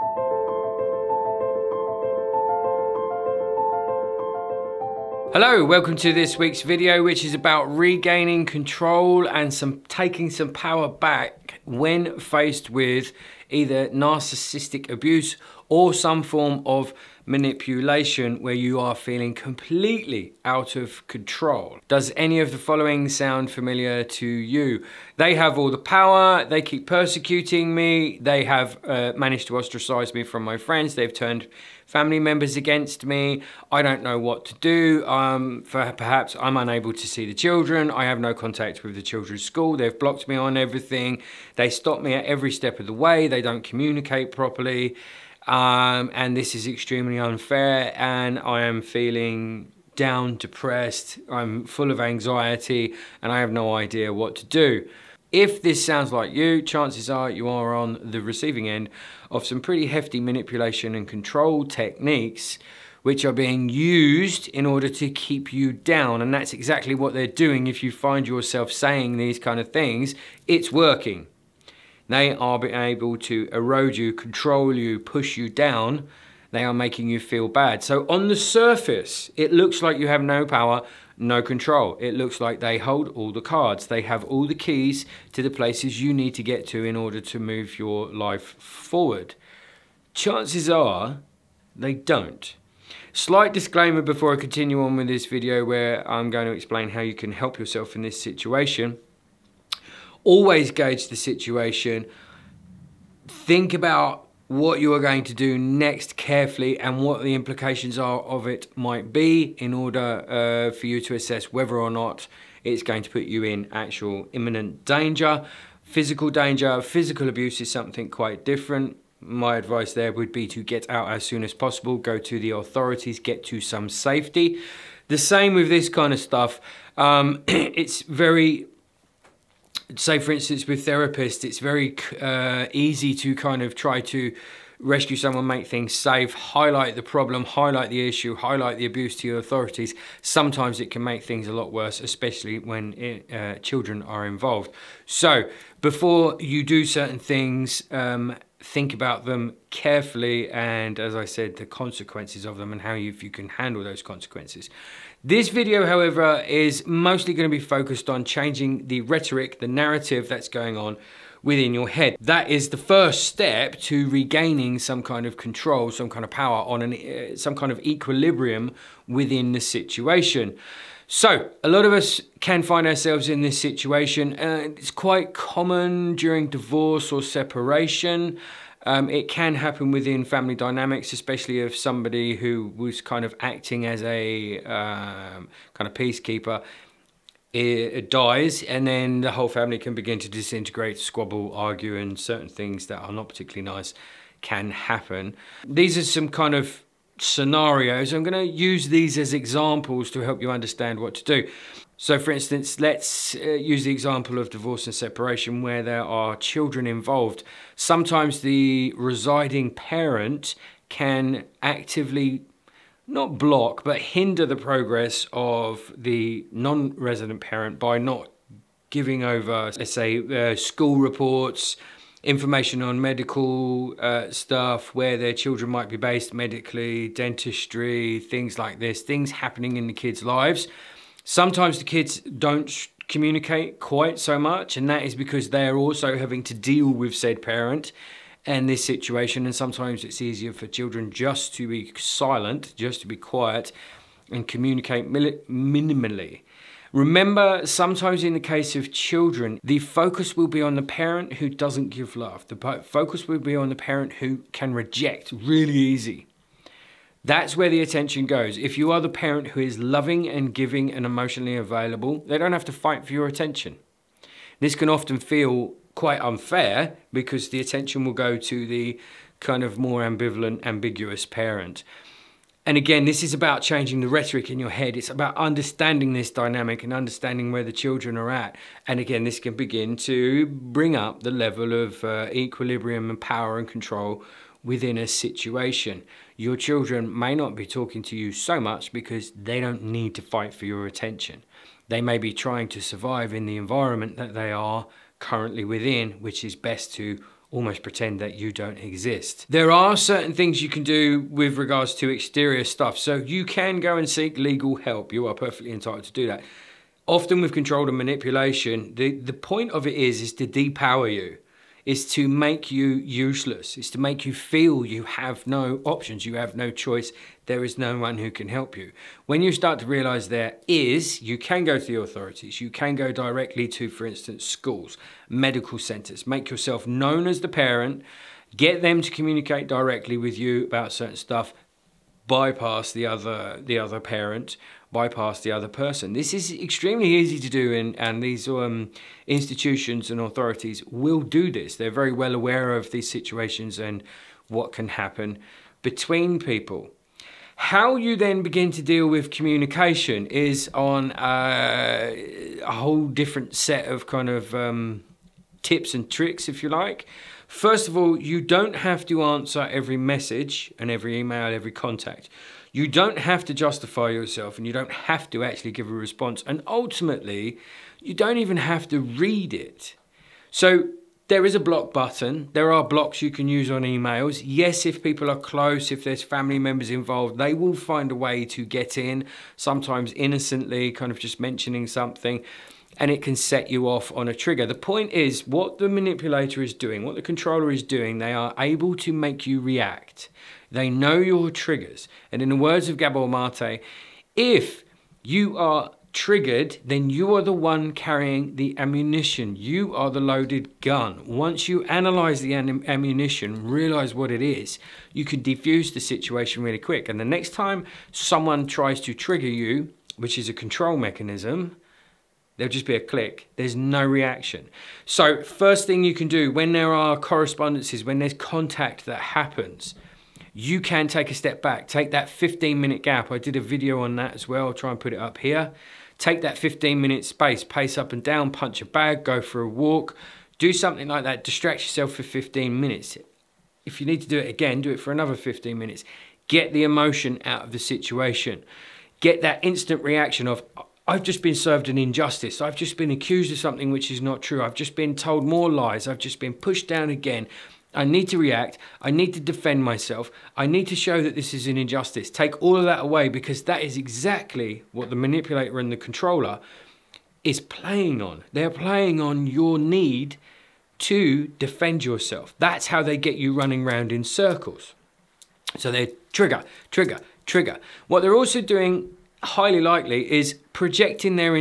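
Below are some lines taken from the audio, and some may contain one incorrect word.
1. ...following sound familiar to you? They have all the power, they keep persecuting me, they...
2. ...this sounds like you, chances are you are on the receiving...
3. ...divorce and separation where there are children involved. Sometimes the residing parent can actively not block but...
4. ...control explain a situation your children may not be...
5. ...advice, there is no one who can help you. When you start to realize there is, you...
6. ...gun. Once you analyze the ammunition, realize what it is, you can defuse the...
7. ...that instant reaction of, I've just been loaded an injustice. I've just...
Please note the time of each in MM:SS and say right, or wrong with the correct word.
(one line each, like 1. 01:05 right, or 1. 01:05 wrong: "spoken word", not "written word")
1. 00:22 right
2. 00:55 right
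3. 03:24 right
4. 04:43 wrong: "within", not "explain"
5. 05:16 wrong: "choice", not "advice"
6. 06:40 right
7. 07:19 wrong: "served", not "loaded".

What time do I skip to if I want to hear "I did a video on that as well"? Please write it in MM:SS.
07:03.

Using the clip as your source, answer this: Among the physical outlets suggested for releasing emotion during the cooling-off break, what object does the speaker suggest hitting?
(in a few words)
a bag.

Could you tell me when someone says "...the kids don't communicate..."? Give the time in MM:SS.
03:51.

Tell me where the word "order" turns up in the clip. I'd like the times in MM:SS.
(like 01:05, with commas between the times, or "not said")
01:04, 01:26, 01:49.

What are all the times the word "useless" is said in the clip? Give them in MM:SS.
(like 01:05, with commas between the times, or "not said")
05:12.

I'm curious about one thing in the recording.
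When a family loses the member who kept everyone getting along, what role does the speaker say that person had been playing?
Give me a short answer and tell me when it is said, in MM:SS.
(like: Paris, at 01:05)
peacekeeper, at 03:05.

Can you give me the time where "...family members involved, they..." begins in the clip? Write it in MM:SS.
06:16.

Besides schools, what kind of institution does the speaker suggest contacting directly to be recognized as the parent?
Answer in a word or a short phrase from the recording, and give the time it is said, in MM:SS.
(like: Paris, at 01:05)
medical centers, at 05:25.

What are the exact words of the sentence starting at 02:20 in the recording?
Sometimes it can make things a lot worse, especially when it, uh, children are involved.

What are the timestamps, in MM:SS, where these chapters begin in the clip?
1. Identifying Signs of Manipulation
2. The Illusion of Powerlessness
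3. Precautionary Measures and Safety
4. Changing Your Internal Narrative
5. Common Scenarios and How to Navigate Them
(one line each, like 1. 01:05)
1. 00:21
2. 01:15
3. 02:04
4. 02:41
5. 03:14.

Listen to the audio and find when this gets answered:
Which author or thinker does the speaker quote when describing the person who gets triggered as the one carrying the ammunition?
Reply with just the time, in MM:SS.
06:32.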